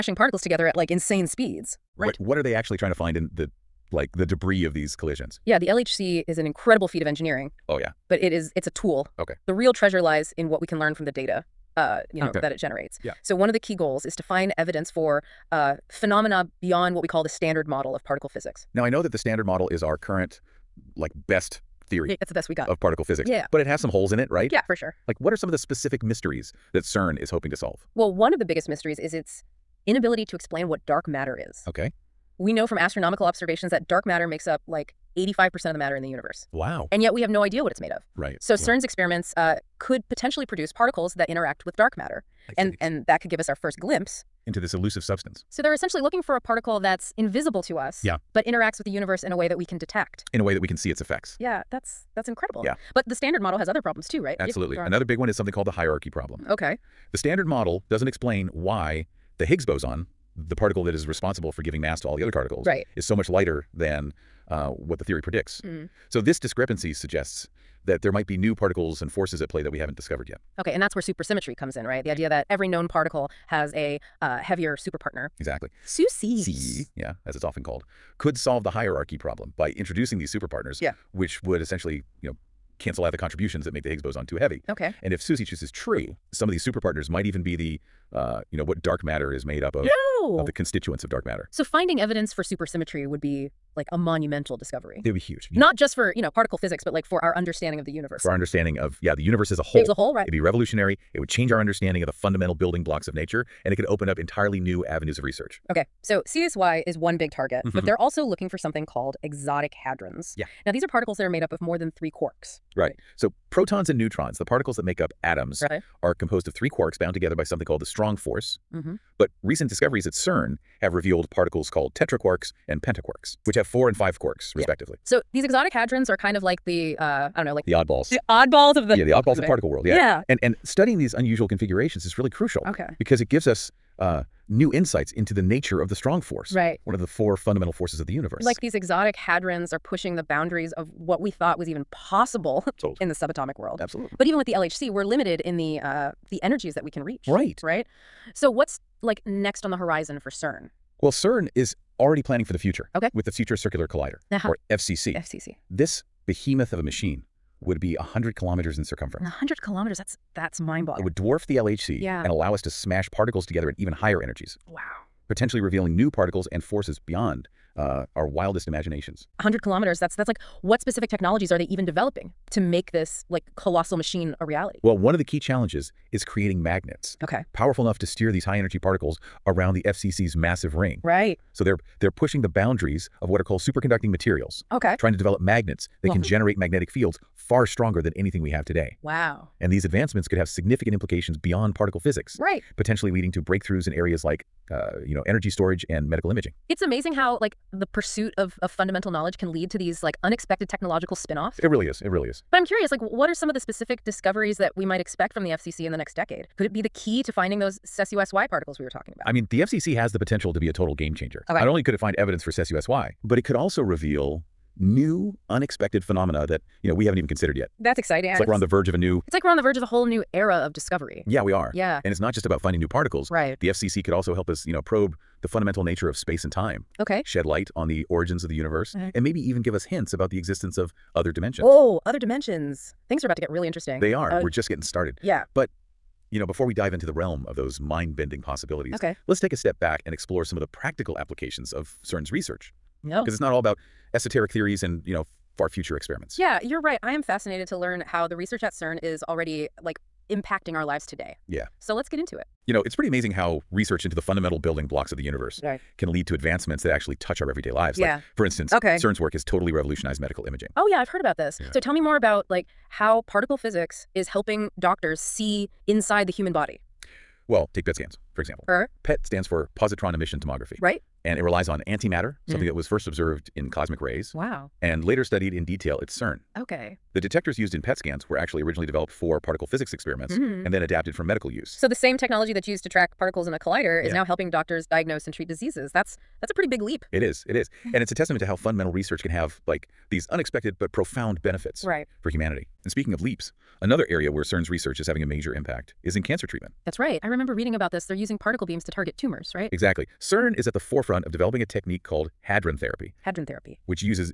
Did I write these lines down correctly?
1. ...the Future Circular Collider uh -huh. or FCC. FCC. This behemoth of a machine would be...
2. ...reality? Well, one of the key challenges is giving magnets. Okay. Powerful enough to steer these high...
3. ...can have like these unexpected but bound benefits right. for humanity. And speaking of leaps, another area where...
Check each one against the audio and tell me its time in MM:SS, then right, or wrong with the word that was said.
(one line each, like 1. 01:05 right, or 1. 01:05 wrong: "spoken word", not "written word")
1. 02:33 right
2. 02:54 wrong: "creating", not "giving"
3. 04:49 wrong: "profound", not "bound".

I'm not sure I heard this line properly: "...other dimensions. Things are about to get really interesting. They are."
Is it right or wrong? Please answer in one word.
right.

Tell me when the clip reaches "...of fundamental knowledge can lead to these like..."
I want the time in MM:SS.
03:18.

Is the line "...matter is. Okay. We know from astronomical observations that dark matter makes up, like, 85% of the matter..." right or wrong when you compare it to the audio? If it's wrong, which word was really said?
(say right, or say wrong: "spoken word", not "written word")
right.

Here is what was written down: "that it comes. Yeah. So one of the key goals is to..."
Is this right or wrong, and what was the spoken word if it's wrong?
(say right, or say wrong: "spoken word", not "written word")
wrong: "generates", not "comes".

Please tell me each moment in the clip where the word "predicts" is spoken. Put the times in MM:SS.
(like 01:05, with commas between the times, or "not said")
01:05.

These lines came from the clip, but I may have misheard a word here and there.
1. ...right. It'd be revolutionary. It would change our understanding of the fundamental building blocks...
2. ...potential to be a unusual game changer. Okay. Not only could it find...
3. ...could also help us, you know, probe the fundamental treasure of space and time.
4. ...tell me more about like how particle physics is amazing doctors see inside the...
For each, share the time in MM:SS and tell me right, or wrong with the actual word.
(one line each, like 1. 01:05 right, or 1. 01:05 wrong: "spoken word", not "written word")
1. 01:40 right
2. 03:30 wrong: "total", not "unusual"
3. 03:44 wrong: "nature", not "treasure"
4. 04:21 wrong: "helping", not "amazing".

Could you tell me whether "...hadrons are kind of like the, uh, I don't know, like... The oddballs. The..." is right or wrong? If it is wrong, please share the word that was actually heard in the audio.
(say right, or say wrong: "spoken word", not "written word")
right.